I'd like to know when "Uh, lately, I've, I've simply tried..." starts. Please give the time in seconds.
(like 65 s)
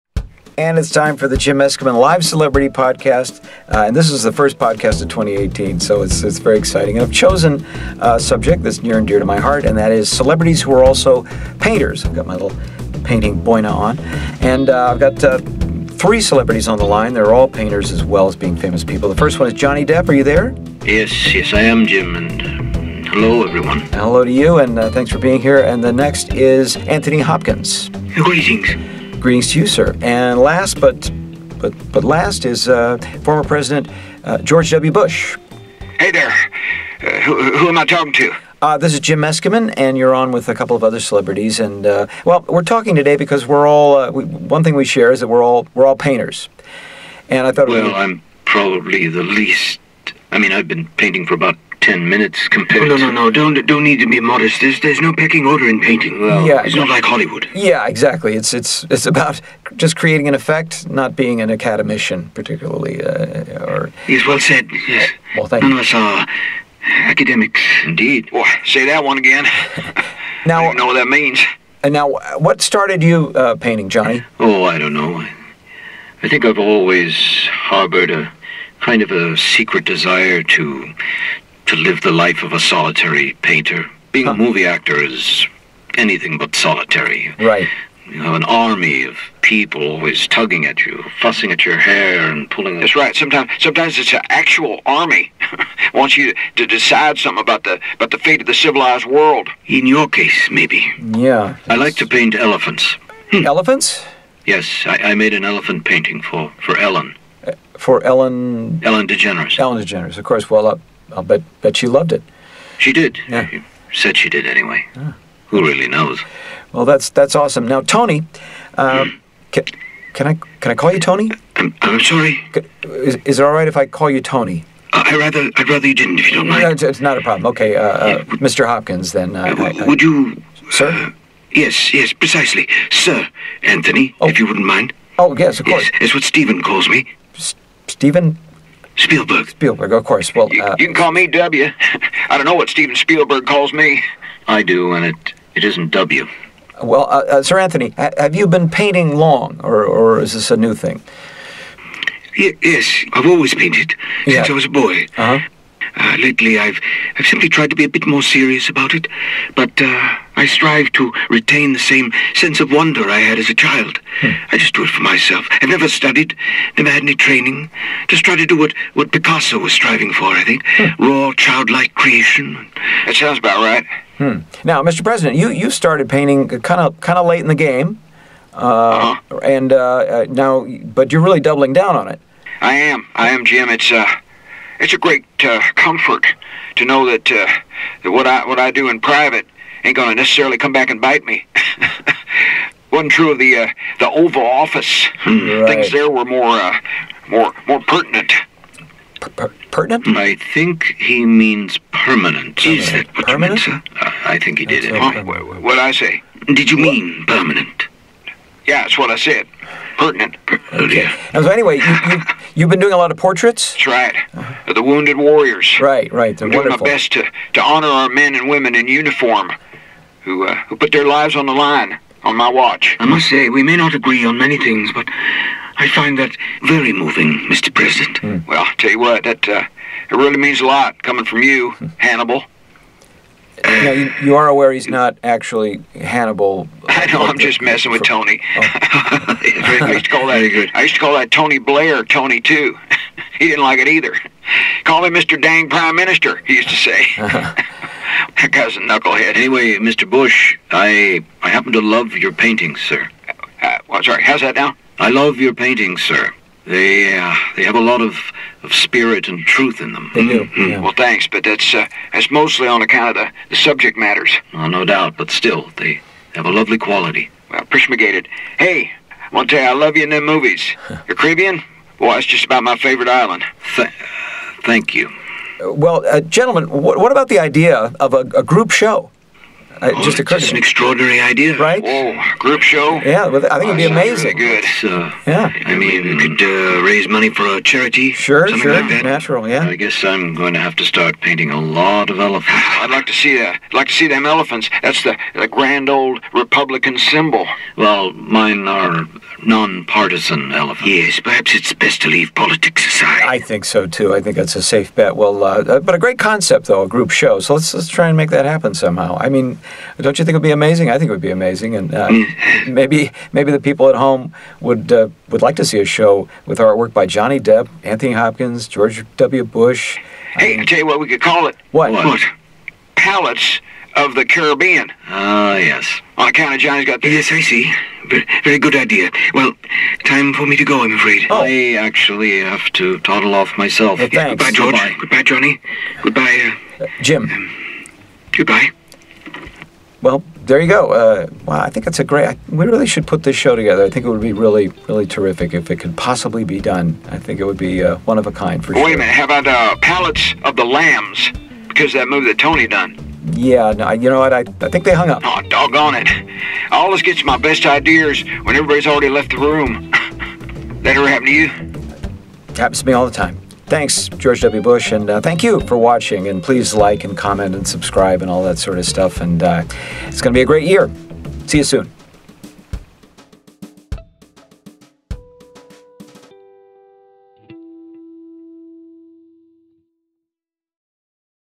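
155 s.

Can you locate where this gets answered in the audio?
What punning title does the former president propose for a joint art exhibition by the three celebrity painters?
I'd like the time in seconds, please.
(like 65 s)
322 s.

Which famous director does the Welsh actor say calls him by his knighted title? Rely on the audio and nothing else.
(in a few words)
Stephen Spielberg.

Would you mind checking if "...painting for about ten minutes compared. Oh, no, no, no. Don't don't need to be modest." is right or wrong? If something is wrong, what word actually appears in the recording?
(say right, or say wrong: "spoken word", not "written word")
right.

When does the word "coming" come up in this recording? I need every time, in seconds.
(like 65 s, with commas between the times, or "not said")
231 s.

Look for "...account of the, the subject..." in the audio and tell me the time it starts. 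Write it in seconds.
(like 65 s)
262 s.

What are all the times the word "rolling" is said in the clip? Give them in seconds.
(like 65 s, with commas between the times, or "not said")
not said.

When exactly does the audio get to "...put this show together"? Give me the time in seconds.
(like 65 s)
343 s.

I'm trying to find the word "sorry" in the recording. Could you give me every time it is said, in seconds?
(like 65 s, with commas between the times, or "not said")
121 s, 254 s.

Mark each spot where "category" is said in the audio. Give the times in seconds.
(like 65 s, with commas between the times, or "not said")
not said.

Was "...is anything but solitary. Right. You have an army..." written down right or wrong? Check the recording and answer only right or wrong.
right.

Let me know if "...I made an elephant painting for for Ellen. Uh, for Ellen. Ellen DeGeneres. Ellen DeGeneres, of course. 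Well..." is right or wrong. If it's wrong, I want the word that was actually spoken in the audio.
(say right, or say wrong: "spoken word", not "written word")
right.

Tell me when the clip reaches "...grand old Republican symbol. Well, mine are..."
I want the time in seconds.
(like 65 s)
295 s.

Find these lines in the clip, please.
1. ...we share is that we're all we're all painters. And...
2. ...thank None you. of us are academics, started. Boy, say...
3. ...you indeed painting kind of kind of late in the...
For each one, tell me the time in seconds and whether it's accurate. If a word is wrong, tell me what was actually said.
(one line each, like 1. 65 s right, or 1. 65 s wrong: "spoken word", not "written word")
1. 44 s right
2. 65 s wrong: "indeed", not "started"
3. 175 s wrong: "started", not "indeed".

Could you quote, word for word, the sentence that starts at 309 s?
I mean, don't you think it would be amazing?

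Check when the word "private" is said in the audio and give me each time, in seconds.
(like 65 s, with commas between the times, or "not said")
188 s.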